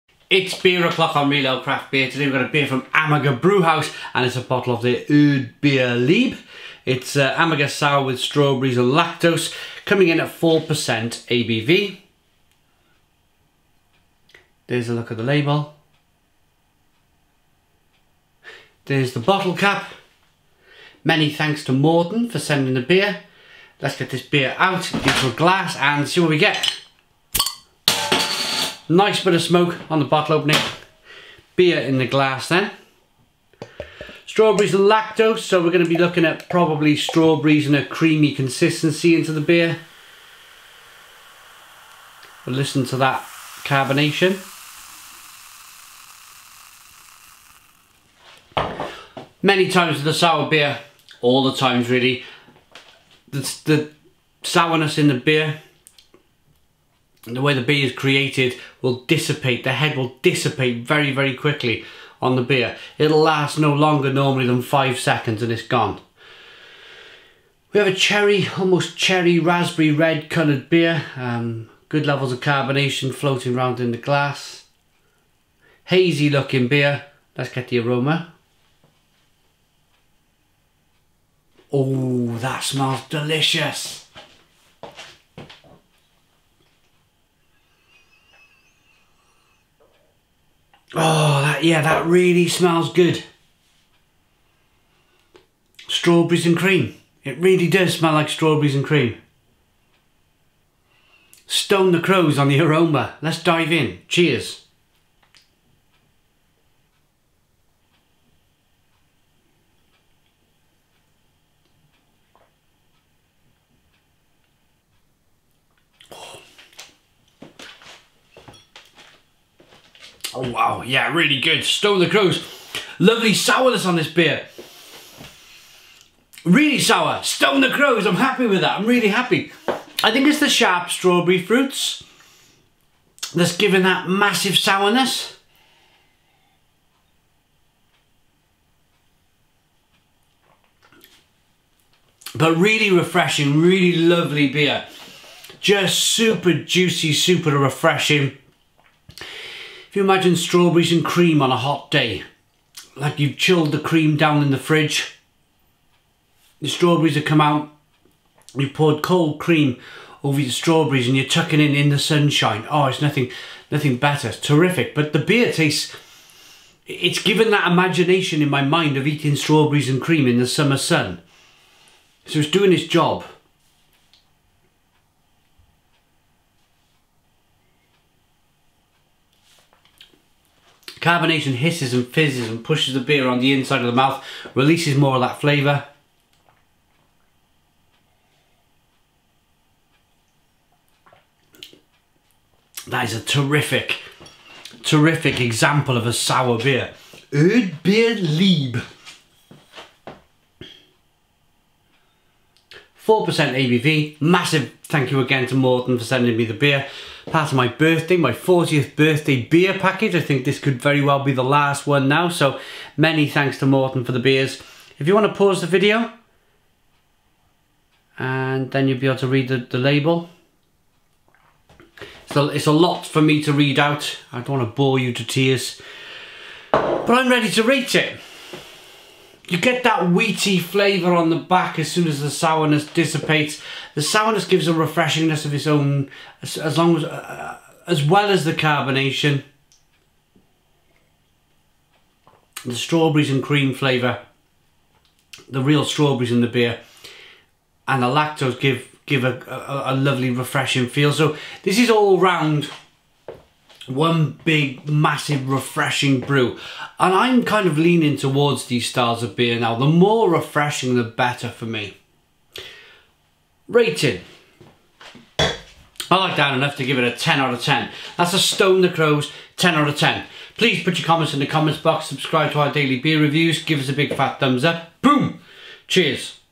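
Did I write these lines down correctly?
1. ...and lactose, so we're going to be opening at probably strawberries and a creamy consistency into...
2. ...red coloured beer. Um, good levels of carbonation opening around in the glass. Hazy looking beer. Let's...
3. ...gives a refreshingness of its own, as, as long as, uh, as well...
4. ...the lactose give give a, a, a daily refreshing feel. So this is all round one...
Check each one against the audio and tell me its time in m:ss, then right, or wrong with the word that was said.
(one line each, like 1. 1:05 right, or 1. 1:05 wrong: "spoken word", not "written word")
1. 0:34 wrong: "looking", not "opening"
2. 1:09 wrong: "floating", not "opening"
3. 3:54 right
4. 4:08 wrong: "lovely", not "daily".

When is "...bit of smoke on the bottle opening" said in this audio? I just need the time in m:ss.
0:29.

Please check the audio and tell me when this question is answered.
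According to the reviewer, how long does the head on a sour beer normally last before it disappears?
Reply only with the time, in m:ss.
1:04.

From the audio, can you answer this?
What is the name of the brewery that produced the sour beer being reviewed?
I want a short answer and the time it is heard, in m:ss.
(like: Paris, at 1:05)
Amager Brewhouse, at 0:02.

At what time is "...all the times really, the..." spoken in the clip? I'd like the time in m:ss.
0:51.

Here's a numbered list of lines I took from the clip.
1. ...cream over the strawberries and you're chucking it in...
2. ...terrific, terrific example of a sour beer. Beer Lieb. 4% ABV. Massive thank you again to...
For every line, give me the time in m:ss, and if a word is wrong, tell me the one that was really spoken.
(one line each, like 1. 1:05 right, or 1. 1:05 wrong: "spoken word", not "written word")
1. 2:39 right
2. 3:13 right.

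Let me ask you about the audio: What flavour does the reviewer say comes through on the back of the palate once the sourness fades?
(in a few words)
wheaty.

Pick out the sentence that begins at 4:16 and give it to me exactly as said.
And I'm kind of leaning towards these styles of beer now.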